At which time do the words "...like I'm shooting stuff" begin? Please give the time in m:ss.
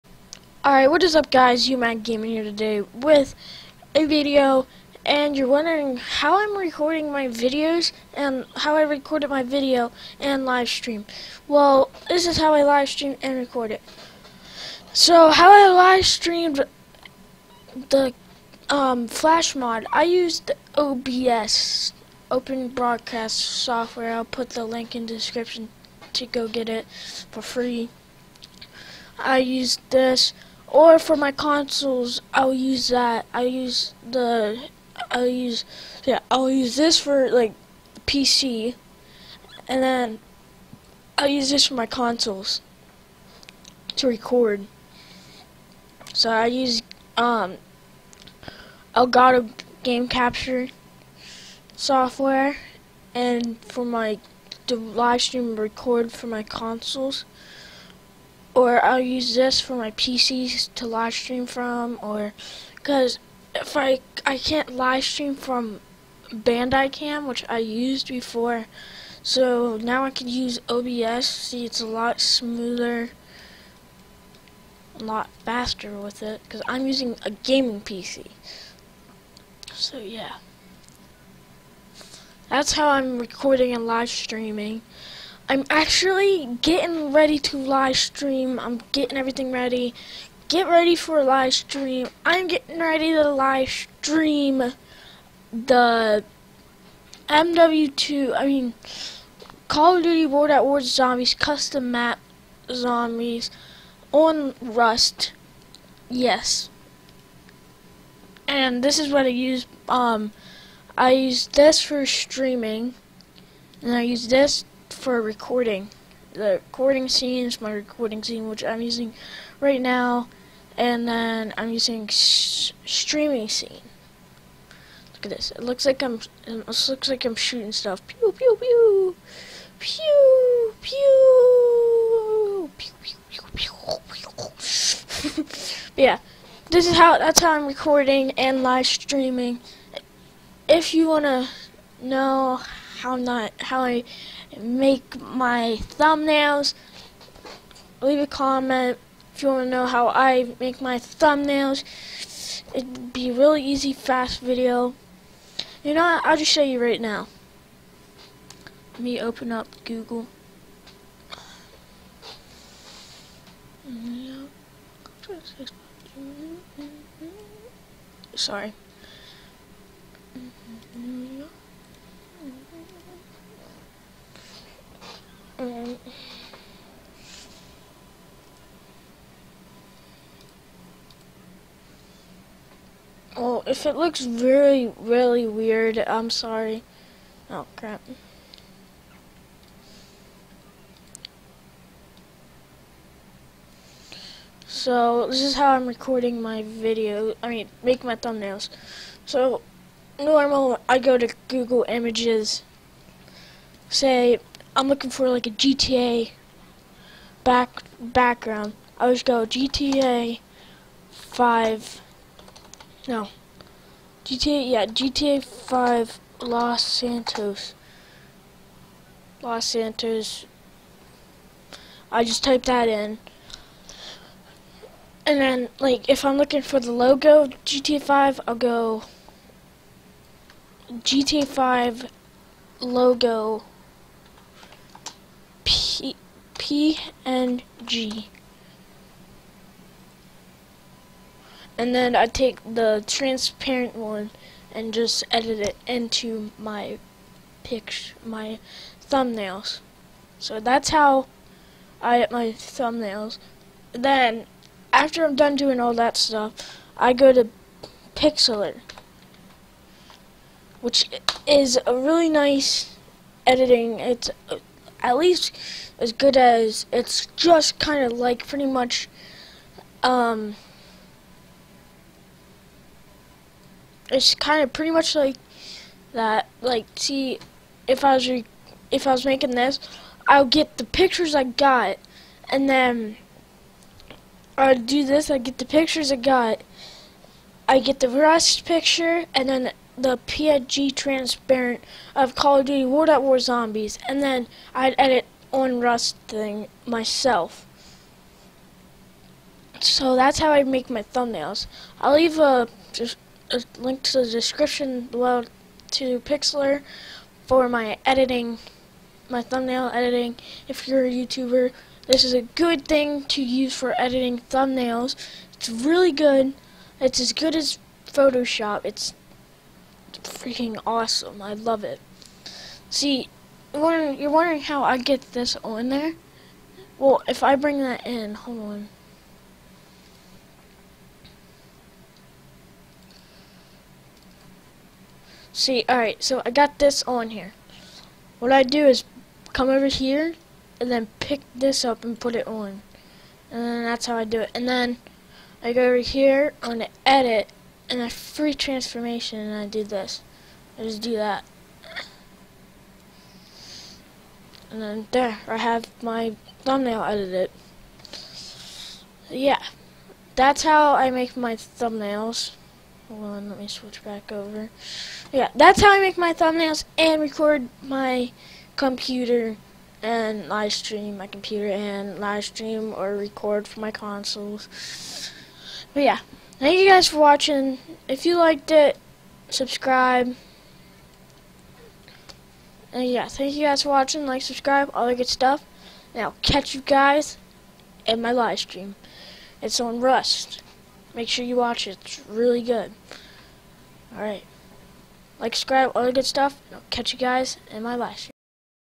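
2:07.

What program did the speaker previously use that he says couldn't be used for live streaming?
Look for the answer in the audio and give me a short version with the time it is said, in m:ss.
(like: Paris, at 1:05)
Bandicam, at 1:06.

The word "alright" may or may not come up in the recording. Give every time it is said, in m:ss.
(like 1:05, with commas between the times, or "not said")
0:00, 5:35, 6:34.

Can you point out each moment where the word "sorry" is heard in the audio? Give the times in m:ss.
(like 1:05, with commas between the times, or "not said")
2:48, 3:06.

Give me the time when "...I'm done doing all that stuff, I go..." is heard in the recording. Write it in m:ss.
4:15.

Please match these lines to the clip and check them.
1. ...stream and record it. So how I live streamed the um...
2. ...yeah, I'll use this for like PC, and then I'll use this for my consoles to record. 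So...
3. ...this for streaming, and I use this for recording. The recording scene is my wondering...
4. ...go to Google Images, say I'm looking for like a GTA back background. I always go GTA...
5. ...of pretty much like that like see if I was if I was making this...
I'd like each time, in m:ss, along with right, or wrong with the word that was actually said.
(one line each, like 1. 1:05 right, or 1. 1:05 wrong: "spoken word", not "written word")
1. 0:12 right
2. 0:36 right
3. 1:51 wrong: "recording", not "wondering"
4. 3:20 right
5. 4:34 right.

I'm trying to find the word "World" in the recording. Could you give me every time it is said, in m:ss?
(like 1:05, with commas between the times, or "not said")
1:40, 4:52.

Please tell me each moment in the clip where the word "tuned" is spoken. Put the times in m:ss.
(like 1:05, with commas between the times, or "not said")
not said.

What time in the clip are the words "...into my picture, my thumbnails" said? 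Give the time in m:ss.
4:05.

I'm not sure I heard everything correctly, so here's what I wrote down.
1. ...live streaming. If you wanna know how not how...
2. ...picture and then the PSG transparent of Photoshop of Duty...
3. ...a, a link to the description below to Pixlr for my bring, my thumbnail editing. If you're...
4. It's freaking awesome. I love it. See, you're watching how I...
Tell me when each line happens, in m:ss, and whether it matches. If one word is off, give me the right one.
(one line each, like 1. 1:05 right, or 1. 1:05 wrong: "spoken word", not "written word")
1. 2:18 right
2. 4:48 wrong: "Call", not "Photoshop"
3. 5:02 wrong: "editing", not "bring"
4. 5:18 wrong: "wondering", not "watching".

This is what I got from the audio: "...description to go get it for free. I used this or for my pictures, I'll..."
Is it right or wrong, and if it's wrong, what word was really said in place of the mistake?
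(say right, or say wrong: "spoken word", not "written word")
wrong: "consoles", not "pictures".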